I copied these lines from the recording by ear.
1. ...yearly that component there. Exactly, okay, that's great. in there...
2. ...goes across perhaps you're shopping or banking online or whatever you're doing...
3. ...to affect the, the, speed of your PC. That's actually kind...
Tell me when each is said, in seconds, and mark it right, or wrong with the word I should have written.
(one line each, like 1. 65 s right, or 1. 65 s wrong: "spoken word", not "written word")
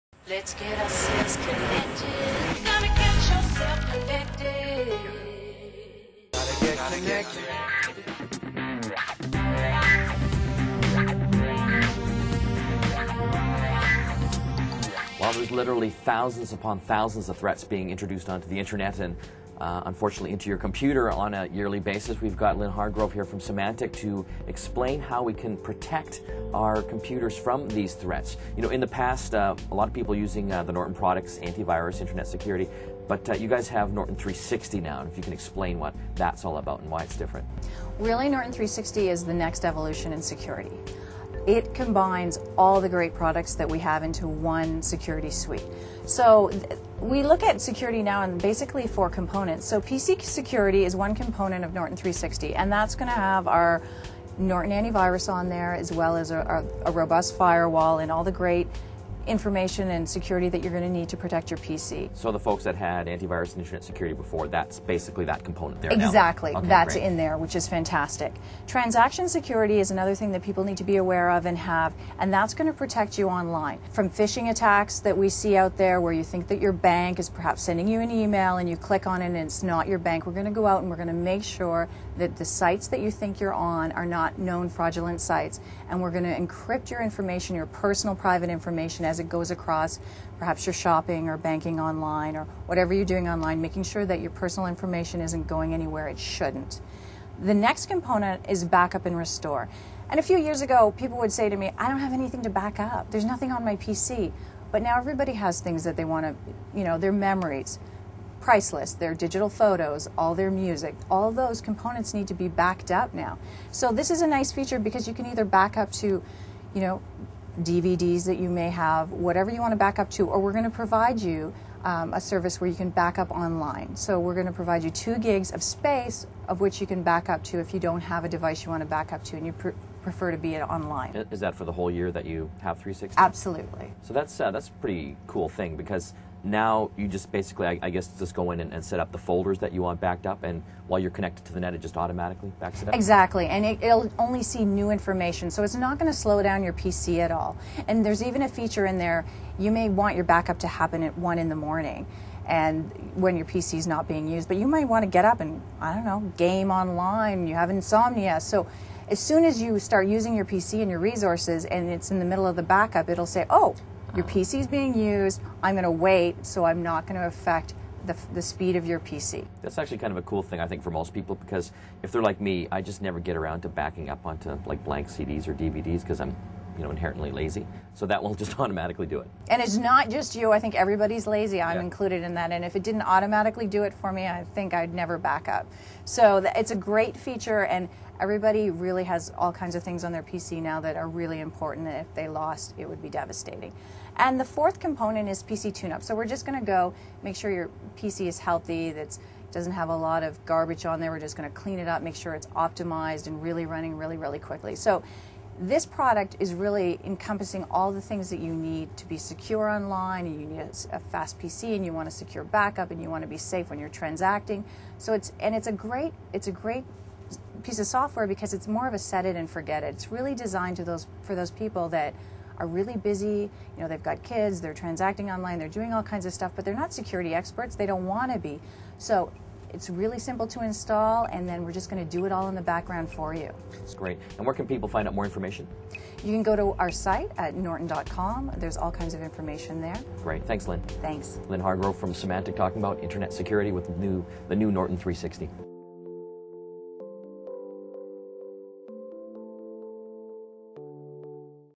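1. 64 s wrong: "basically", not "yearly"
2. 89 s right
3. 167 s right.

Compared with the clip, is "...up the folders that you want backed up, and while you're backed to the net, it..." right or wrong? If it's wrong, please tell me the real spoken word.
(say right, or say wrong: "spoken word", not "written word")
wrong: "connected", not "backed".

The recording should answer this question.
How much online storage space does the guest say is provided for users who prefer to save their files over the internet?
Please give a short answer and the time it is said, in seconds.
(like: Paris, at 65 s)
2 gigs, at 124 s.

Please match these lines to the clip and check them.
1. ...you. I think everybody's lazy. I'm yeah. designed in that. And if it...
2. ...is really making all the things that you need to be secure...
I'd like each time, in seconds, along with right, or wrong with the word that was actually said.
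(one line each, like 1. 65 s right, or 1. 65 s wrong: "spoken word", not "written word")
1. 180 s wrong: "included", not "designed"
2. 206 s wrong: "encompassing", not "making".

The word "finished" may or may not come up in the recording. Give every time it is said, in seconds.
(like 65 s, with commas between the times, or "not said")
not said.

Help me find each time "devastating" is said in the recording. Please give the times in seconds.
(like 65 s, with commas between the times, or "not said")
193 s.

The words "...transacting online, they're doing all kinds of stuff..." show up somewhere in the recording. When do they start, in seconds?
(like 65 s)
224 s.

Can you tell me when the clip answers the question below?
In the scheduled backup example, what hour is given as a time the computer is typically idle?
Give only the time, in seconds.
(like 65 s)
151 s.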